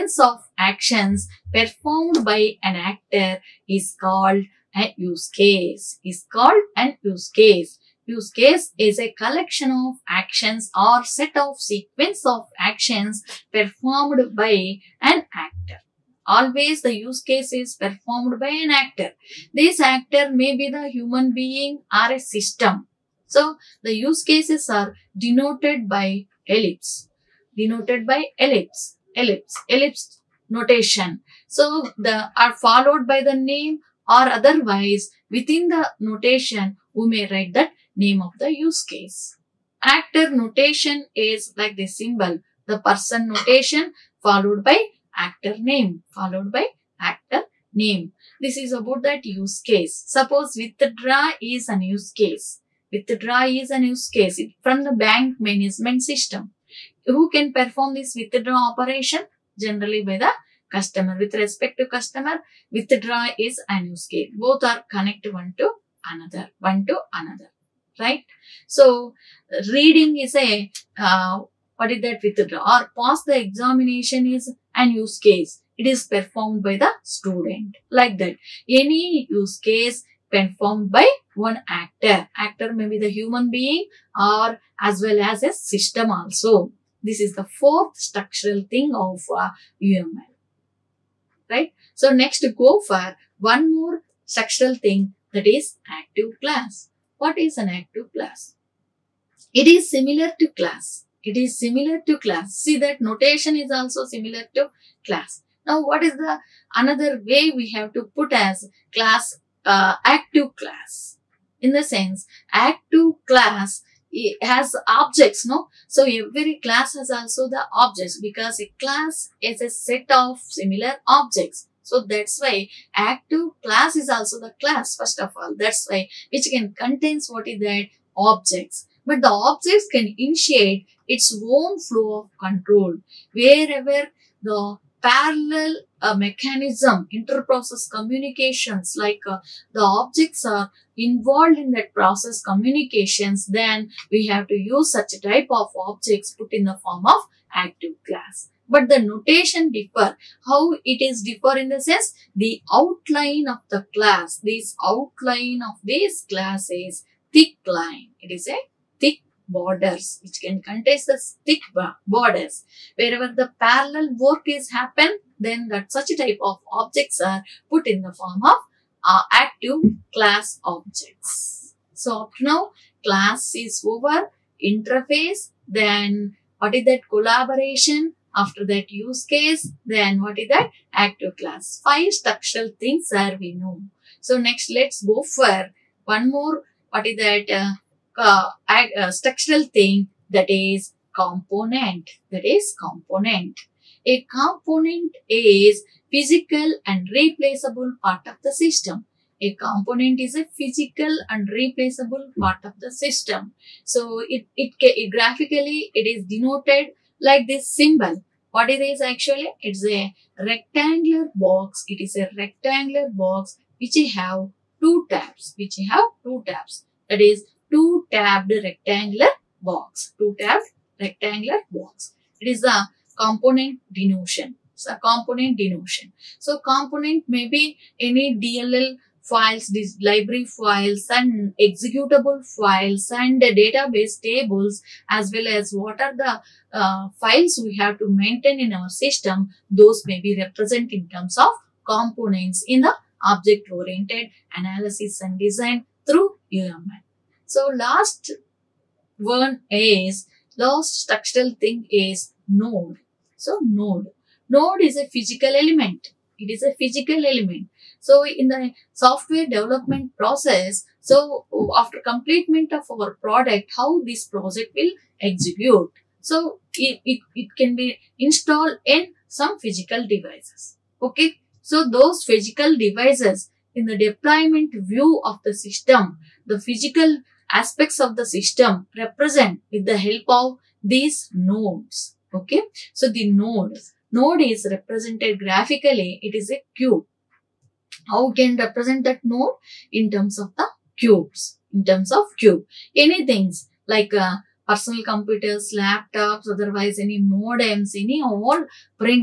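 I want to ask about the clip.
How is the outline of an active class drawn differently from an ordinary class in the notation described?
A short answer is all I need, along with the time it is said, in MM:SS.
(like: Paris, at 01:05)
Thick line, at 02:37.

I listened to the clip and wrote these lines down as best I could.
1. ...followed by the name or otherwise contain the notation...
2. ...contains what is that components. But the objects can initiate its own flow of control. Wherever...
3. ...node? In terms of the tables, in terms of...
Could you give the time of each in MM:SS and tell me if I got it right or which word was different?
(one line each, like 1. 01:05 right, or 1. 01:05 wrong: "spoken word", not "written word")
1. 00:32 wrong: "within", not "contain"
2. 02:06 wrong: "objects", not "components"
3. 04:49 wrong: "cubes", not "tables".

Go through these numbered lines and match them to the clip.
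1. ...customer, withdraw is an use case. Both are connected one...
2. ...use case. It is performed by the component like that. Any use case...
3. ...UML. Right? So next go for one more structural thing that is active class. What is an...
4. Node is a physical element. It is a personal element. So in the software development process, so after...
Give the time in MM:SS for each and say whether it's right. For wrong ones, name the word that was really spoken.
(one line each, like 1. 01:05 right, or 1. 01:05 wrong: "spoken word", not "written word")
1. 01:01 right
2. 01:14 wrong: "student", not "component"
3. 01:29 right
4. 04:14 wrong: "physical", not "personal".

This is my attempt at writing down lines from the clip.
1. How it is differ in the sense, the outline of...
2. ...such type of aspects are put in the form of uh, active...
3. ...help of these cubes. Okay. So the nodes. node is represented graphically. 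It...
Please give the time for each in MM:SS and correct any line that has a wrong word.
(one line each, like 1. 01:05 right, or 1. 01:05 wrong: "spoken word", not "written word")
1. 02:30 right
2. 02:45 wrong: "objects", not "aspects"
3. 04:39 wrong: "nodes", not "cubes".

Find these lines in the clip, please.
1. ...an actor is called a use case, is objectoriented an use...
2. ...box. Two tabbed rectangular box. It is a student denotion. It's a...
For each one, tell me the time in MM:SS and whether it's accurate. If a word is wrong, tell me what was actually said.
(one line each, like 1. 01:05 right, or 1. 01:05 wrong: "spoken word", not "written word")
1. 00:02 wrong: "called", not "objectoriented"
2. 03:39 wrong: "component", not "student".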